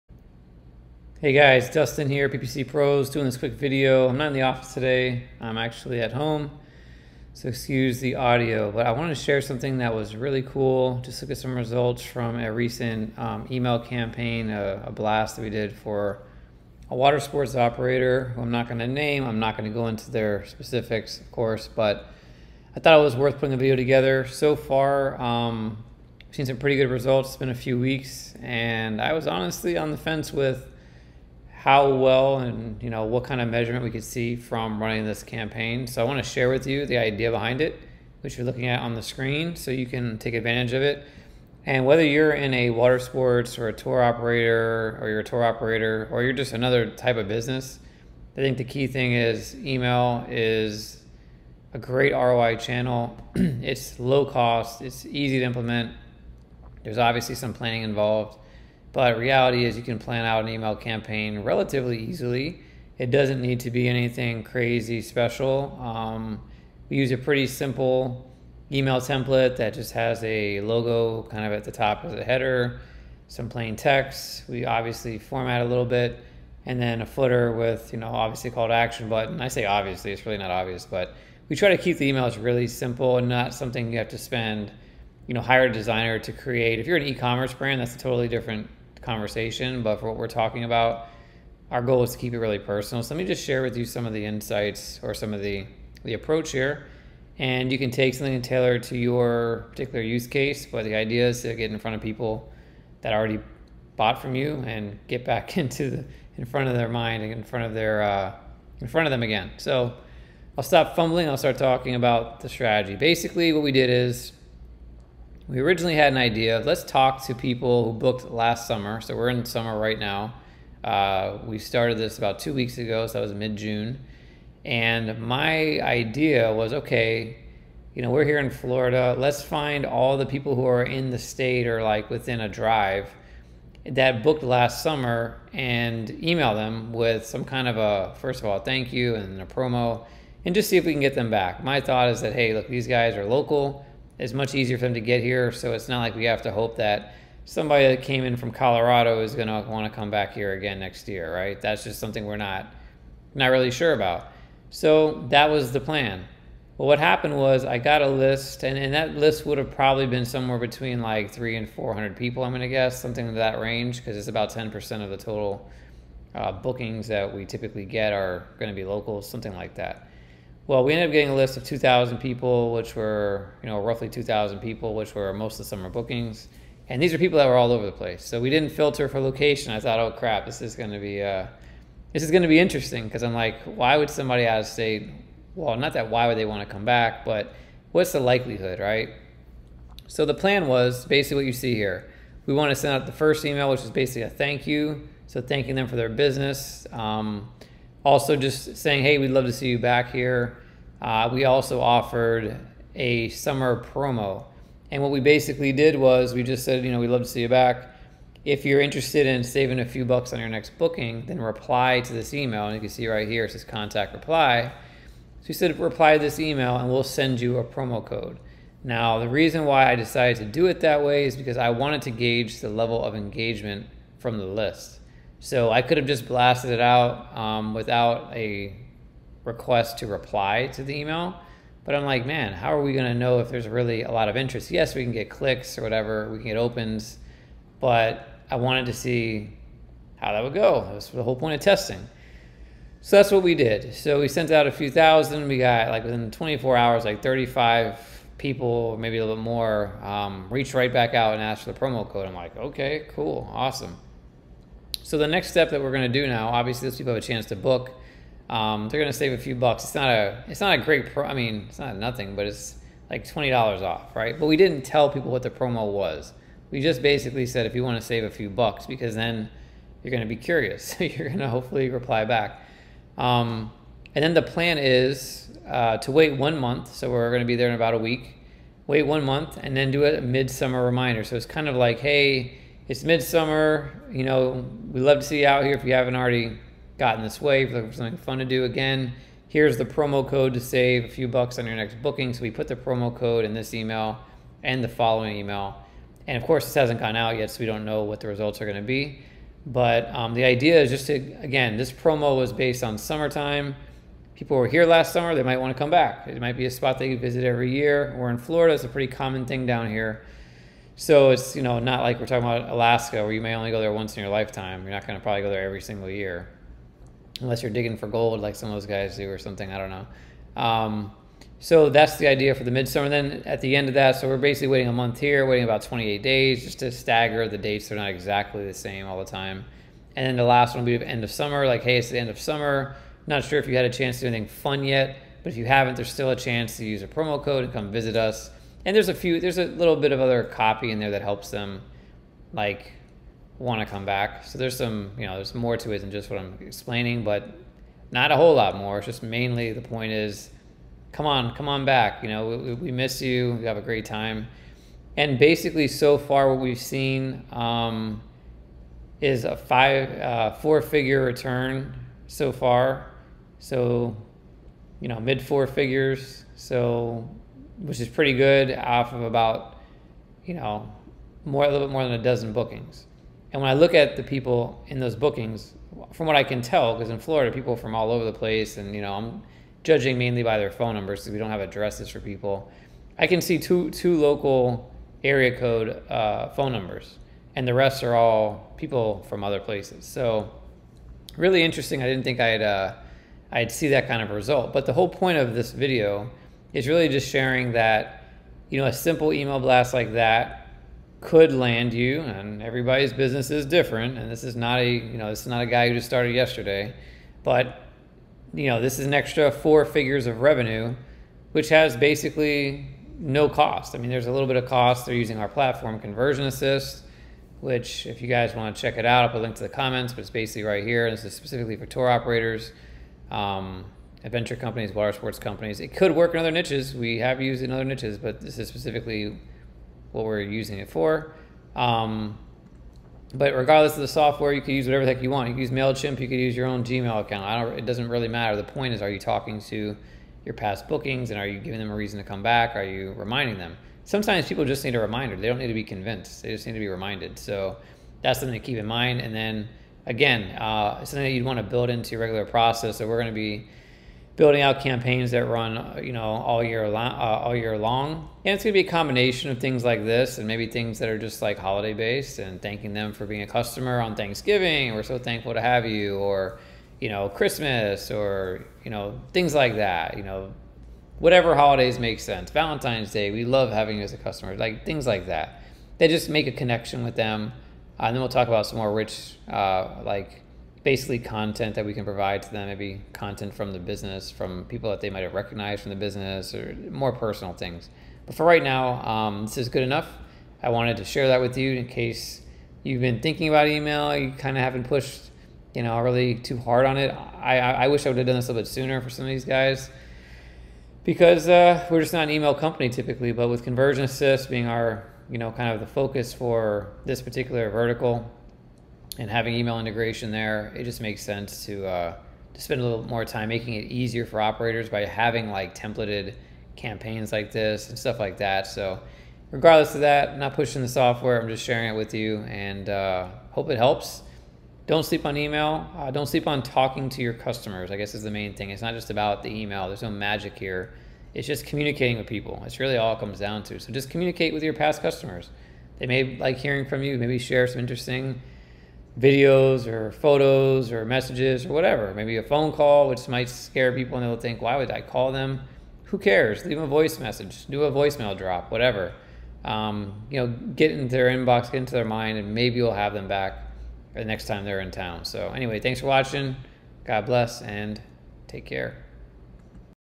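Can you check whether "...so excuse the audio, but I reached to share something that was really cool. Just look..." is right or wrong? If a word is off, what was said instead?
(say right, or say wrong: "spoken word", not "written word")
wrong: "wanted", not "reached".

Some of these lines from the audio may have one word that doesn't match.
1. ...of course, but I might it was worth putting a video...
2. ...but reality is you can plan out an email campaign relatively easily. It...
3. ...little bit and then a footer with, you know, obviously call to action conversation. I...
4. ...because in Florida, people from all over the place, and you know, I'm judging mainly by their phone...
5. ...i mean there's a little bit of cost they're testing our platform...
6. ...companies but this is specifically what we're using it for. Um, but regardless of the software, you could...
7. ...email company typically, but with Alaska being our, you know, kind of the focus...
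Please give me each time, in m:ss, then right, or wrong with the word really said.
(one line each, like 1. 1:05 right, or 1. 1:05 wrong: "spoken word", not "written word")
1. 0:21 wrong: "thought", not "might"
2. 0:58 right
3. 1:15 wrong: "button", not "conversation"
4. 6:16 right
5. 6:53 wrong: "using", not "testing"
6. 7:07 wrong: "niches", not "companies"
7. 8:22 wrong: "ConversionAssist", not "Alaska".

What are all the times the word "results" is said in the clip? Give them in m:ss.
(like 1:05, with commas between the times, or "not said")
0:11, 0:26, 4:58, 6:34.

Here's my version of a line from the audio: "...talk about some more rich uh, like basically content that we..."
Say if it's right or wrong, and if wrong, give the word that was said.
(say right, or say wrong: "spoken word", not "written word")
right.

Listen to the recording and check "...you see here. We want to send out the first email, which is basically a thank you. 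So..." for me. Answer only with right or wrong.
right.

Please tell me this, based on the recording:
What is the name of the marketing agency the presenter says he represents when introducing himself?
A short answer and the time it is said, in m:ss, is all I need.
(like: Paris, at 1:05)
PPC Pros, at 0:02.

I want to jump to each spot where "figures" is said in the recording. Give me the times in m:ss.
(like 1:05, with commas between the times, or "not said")
6:00, 6:05, 6:49.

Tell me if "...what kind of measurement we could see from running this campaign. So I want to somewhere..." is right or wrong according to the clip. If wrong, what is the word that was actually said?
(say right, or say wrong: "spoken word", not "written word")
wrong: "share", not "somewhere".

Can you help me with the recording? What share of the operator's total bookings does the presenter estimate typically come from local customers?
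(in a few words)
10%.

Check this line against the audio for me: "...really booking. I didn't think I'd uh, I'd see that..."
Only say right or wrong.
wrong.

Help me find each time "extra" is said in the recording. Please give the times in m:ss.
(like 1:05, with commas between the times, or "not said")
6:49.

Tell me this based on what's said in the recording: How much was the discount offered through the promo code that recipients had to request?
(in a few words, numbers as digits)
twenty dollars.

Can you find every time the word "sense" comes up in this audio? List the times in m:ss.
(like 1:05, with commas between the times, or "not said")
7:52, 8:31.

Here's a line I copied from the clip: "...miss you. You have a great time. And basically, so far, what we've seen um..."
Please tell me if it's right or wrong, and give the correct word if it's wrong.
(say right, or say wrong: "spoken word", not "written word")
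right.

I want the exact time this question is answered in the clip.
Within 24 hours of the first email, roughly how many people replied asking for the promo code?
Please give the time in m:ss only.
4:07.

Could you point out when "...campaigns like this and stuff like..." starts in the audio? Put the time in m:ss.
8:36.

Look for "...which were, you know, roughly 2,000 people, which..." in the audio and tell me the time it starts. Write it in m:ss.
2:52.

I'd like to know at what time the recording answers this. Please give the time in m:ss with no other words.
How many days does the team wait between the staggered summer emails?
5:25.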